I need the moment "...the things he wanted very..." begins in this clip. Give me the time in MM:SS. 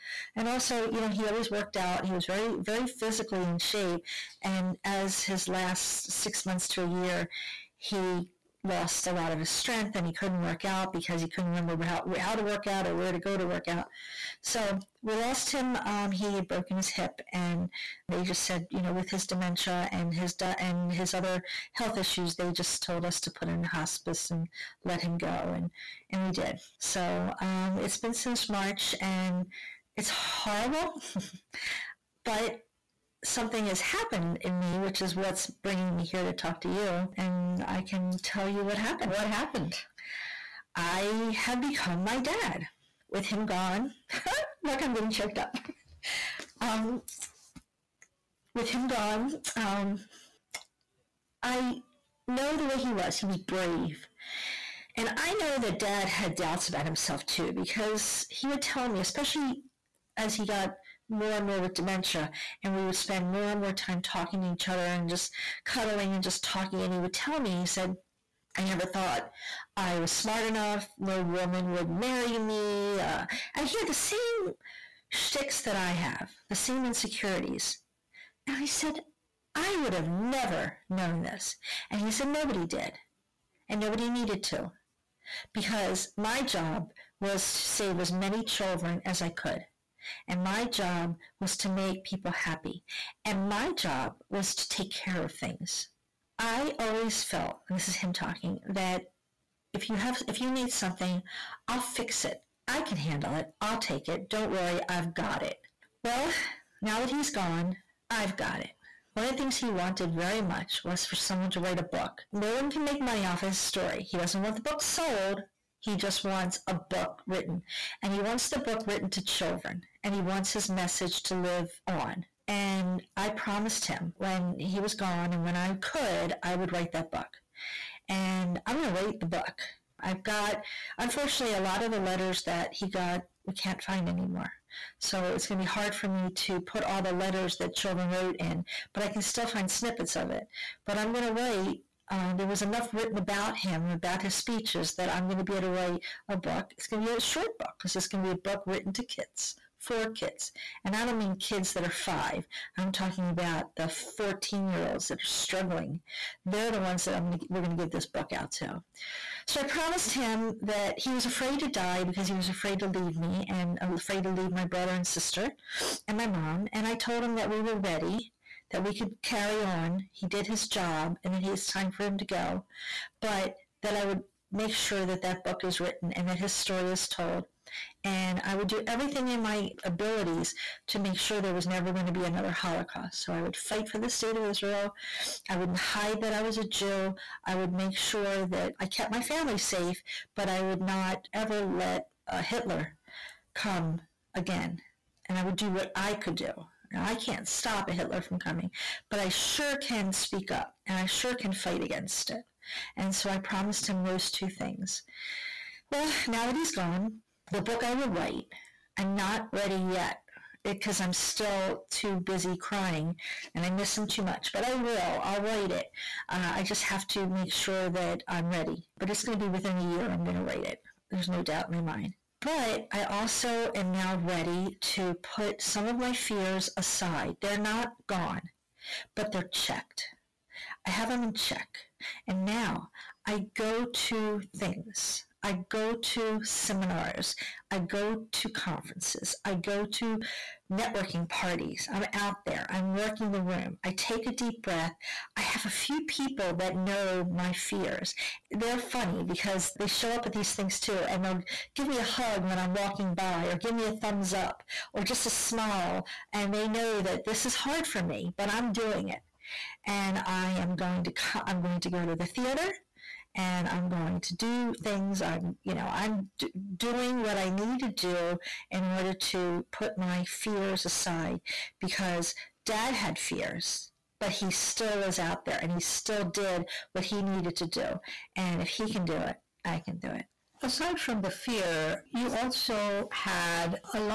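01:49.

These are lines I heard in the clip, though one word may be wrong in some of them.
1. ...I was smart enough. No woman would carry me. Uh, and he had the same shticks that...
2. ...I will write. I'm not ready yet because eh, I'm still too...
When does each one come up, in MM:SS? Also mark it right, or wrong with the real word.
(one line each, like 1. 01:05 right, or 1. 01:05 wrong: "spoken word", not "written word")
1. 01:09 wrong: "marry", not "carry"
2. 03:27 right.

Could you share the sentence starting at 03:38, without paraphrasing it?
But it's going to be within a year, I'm going to write it.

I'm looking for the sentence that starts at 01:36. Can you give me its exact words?
I always felt, and this is him talking, that if you have if you need something, I'll fix it.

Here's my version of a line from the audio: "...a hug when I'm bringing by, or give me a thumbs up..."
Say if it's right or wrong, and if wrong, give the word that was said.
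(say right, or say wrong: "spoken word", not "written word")
wrong: "walking", not "bringing".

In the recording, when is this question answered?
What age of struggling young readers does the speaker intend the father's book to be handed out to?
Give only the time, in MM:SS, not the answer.
02:33.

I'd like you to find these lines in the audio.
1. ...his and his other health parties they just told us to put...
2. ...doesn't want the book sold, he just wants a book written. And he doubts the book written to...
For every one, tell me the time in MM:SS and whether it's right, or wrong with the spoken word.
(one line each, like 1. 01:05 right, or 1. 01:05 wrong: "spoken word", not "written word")
1. 00:20 wrong: "issues", not "parties"
2. 01:54 wrong: "wants", not "doubts".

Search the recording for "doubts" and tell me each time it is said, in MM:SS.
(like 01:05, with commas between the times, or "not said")
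00:56, 03:41.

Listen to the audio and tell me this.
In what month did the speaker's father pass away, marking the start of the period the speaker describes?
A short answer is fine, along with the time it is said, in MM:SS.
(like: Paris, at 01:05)
March, at 00:28.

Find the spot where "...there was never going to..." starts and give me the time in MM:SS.
03:01.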